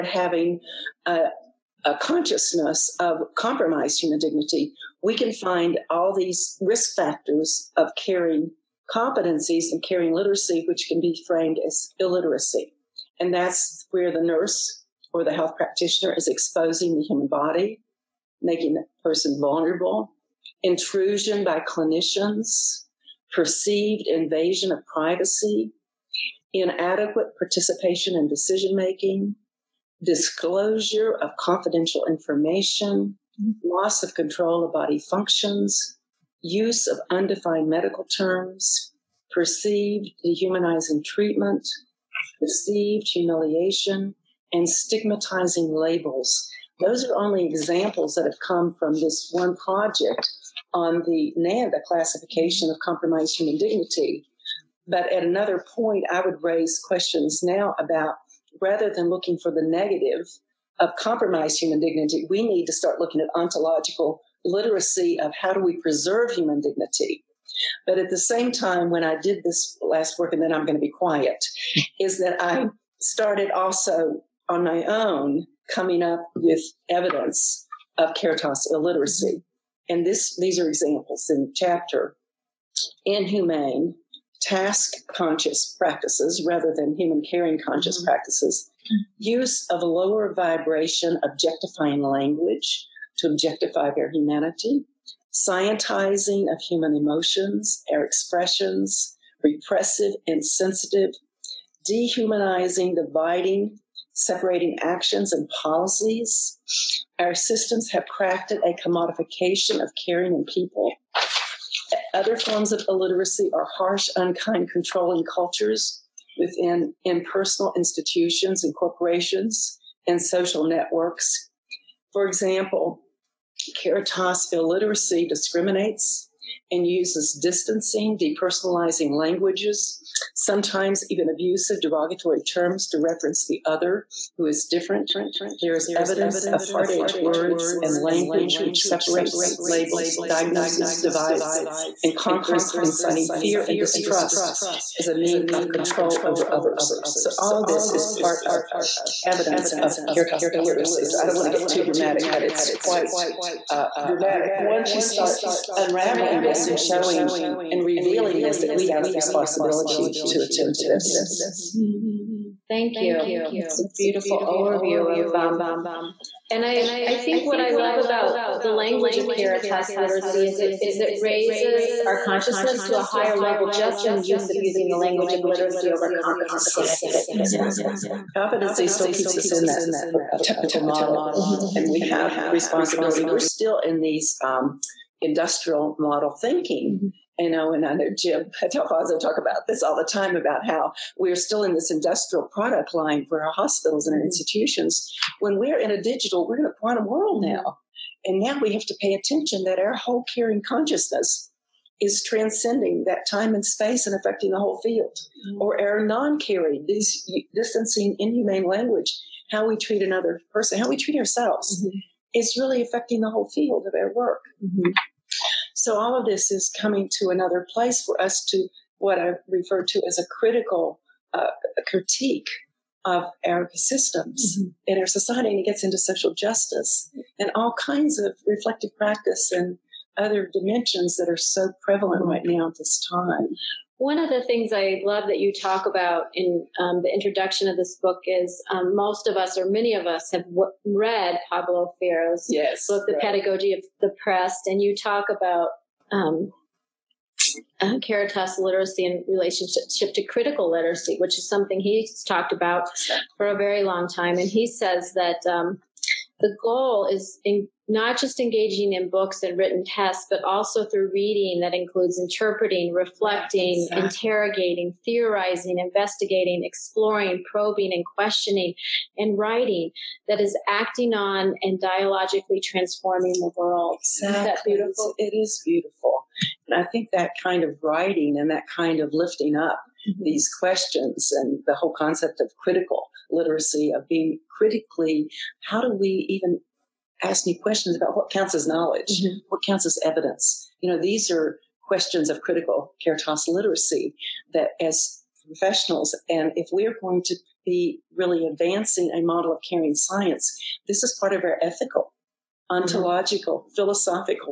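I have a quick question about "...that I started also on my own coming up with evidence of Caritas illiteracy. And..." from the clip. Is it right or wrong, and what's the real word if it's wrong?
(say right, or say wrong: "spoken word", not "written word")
right.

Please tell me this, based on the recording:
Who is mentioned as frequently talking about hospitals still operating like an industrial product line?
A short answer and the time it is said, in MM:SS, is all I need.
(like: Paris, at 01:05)
Jim D'Alfonso, at 03:08.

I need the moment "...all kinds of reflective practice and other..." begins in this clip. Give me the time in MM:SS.
03:47.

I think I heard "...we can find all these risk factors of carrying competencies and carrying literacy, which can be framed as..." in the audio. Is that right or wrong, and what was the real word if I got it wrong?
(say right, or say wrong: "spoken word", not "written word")
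right.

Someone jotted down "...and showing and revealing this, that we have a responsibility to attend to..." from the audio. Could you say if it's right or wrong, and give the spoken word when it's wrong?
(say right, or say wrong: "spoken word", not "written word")
right.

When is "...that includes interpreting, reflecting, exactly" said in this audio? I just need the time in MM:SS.
04:21.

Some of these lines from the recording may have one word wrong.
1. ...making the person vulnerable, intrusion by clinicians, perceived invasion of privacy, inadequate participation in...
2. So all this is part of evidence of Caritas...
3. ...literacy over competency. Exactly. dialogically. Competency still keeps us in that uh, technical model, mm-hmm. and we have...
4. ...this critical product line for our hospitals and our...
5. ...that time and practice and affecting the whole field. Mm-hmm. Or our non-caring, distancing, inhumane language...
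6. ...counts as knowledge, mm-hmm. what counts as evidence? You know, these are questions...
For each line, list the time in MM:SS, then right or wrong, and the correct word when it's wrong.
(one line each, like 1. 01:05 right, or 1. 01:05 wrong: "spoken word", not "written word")
1. 00:18 right
2. 02:27 right
3. 02:55 wrong: "exactly", not "dialogically"
4. 03:11 wrong: "industrial", not "critical"
5. 03:23 wrong: "space", not "practice"
6. 04:48 right.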